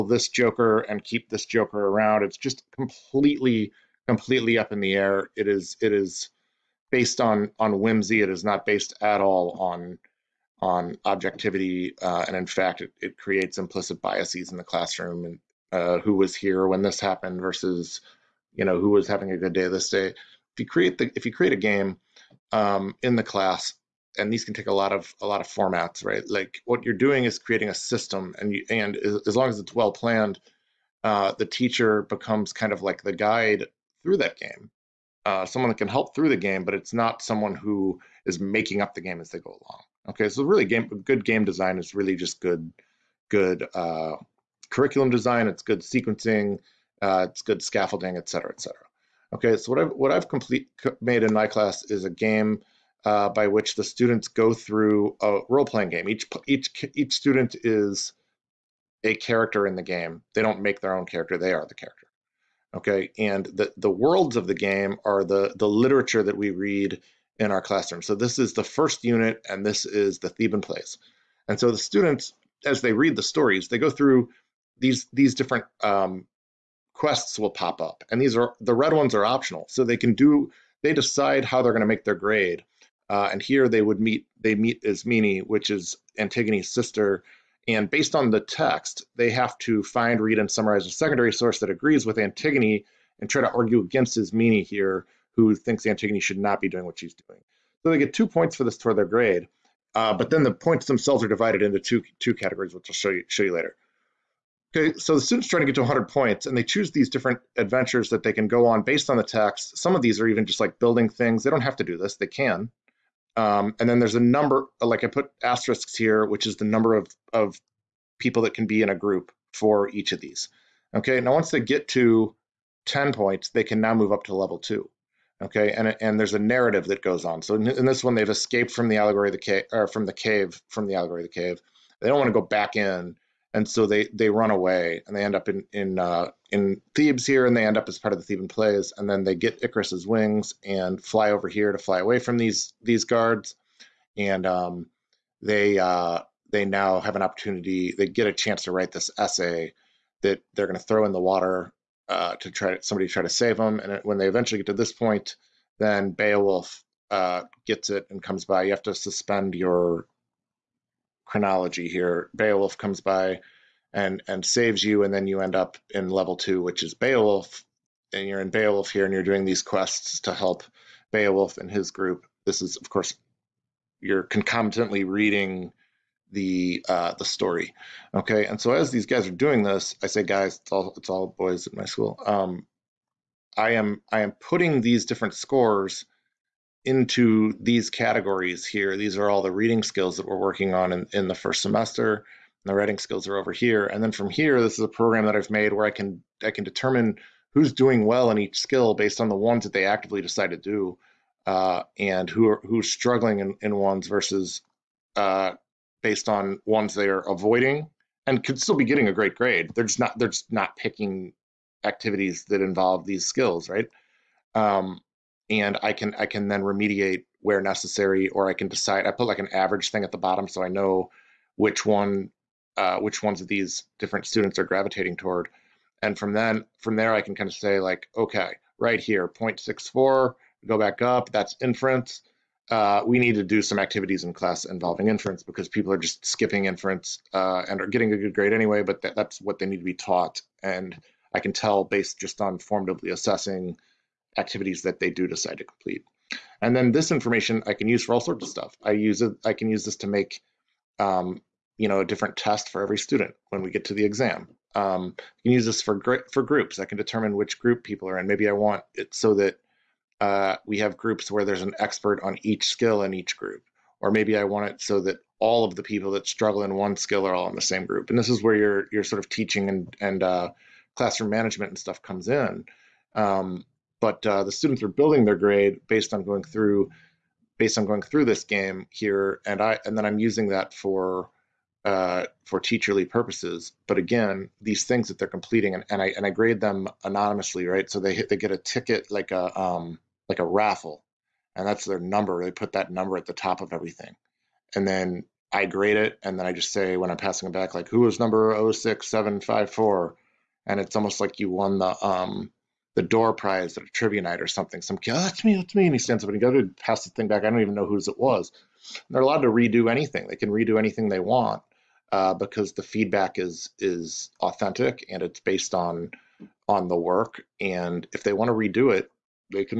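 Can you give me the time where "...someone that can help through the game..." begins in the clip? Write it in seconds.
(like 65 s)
35 s.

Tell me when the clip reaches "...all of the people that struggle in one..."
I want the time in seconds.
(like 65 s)
265 s.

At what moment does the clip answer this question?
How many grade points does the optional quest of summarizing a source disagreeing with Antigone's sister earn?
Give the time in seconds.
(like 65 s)
98 s.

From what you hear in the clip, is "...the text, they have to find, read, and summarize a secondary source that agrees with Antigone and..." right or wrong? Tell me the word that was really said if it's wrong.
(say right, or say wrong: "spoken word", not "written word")
right.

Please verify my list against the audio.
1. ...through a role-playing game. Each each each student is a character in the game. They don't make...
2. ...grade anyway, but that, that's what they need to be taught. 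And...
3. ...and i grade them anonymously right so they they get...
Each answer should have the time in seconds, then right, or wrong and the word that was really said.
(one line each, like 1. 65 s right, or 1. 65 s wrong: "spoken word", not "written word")
1. 54 s right
2. 238 s right
3. 286 s right.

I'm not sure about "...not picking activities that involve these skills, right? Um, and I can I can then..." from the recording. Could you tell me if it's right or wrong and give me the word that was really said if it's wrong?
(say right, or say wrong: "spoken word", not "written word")
right.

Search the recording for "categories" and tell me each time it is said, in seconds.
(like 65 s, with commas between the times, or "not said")
102 s, 187 s.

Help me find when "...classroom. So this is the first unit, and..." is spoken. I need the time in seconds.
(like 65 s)
67 s.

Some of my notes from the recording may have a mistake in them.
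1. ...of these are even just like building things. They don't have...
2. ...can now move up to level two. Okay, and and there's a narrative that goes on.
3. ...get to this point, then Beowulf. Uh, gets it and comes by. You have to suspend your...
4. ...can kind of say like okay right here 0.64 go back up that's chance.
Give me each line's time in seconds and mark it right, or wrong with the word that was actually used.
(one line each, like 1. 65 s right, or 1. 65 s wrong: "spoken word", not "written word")
1. 109 s right
2. 123 s right
3. 154 s right
4. 227 s wrong: "inference", not "chance".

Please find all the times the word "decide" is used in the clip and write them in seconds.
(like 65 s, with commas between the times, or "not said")
80 s, 200 s, 218 s, 245 s.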